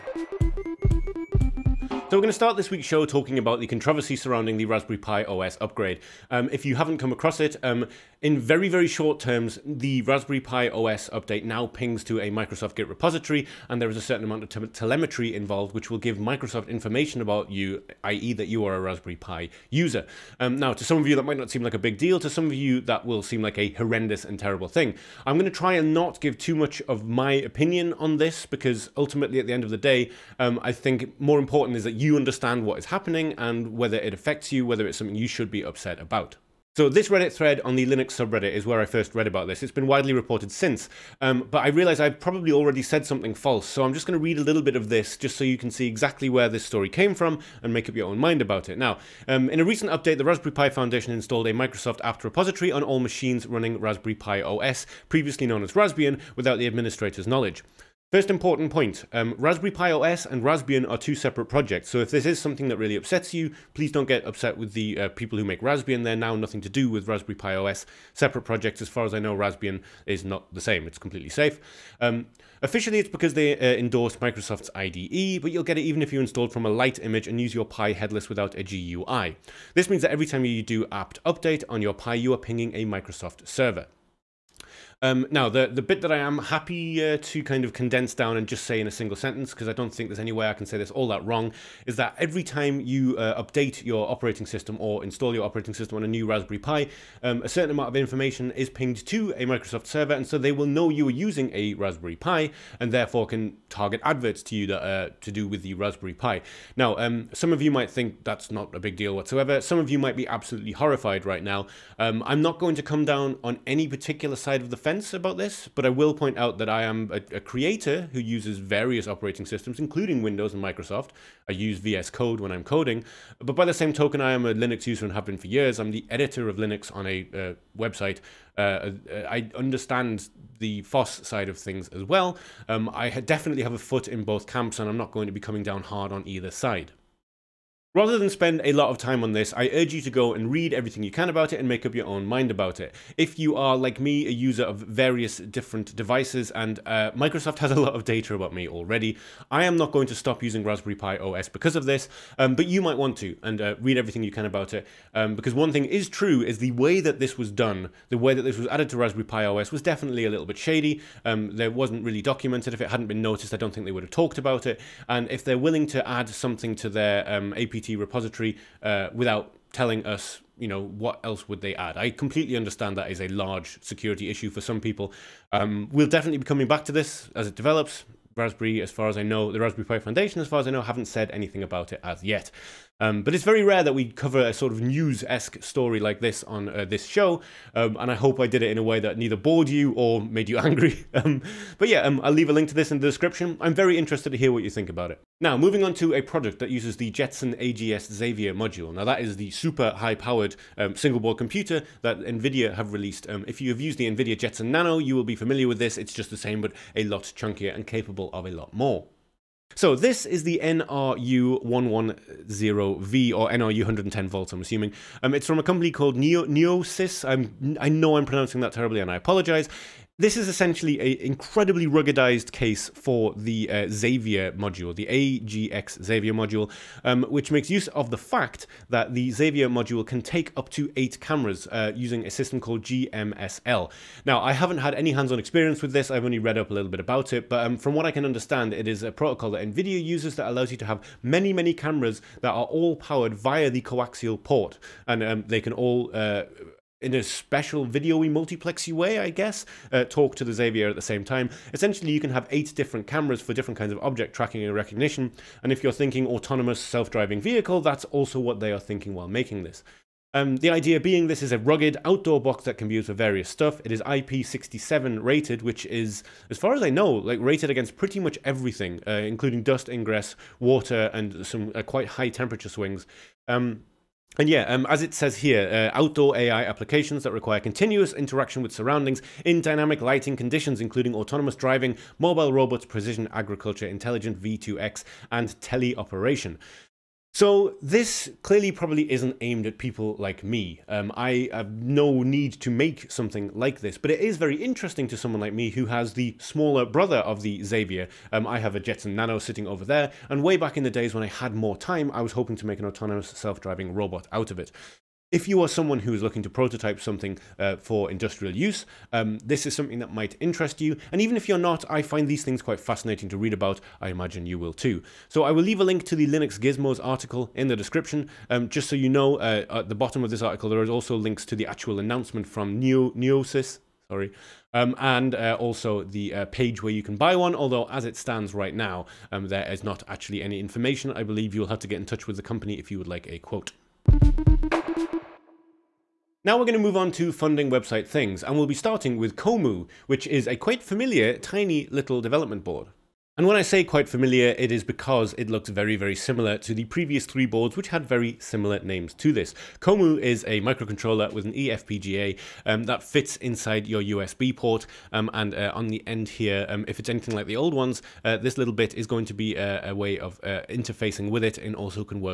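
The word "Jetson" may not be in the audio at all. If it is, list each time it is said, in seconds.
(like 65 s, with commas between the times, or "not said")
197 s, 204 s, 298 s.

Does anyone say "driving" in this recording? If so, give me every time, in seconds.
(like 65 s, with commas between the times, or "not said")
256 s, 281 s, 303 s.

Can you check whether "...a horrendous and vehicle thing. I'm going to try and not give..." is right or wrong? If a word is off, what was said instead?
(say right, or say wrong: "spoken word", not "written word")
wrong: "terrible", not "vehicle".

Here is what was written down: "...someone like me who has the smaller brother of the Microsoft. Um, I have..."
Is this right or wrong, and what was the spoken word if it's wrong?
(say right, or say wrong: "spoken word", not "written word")
wrong: "Xavier", not "Microsoft".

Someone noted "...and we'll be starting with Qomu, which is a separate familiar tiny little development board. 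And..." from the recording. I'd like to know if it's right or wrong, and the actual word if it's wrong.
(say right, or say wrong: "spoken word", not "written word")
wrong: "quite", not "separate".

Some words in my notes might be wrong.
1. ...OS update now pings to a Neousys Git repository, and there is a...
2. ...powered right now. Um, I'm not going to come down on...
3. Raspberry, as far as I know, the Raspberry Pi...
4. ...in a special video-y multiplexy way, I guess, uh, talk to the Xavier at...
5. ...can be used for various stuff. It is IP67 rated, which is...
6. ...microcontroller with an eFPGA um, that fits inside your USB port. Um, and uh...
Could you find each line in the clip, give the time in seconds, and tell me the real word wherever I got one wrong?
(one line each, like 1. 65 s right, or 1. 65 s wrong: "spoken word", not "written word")
1. 10 s wrong: "Microsoft", not "Neousys"
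2. 110 s wrong: "horrified", not "powered"
3. 178 s right
4. 247 s right
5. 262 s right
6. 350 s right.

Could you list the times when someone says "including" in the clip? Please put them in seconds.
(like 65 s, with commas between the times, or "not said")
119 s, 269 s, 280 s.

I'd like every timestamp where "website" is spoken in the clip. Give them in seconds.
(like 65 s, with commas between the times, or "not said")
127 s, 337 s.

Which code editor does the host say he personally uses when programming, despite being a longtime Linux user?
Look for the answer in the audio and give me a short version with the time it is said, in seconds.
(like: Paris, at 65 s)
VS Code, at 121 s.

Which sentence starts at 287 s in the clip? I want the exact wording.
So this clearly probably isn't aimed at people like me.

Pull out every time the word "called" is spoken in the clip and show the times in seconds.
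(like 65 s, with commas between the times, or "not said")
215 s, 232 s.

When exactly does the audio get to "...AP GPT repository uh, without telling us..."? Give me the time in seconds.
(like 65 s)
167 s.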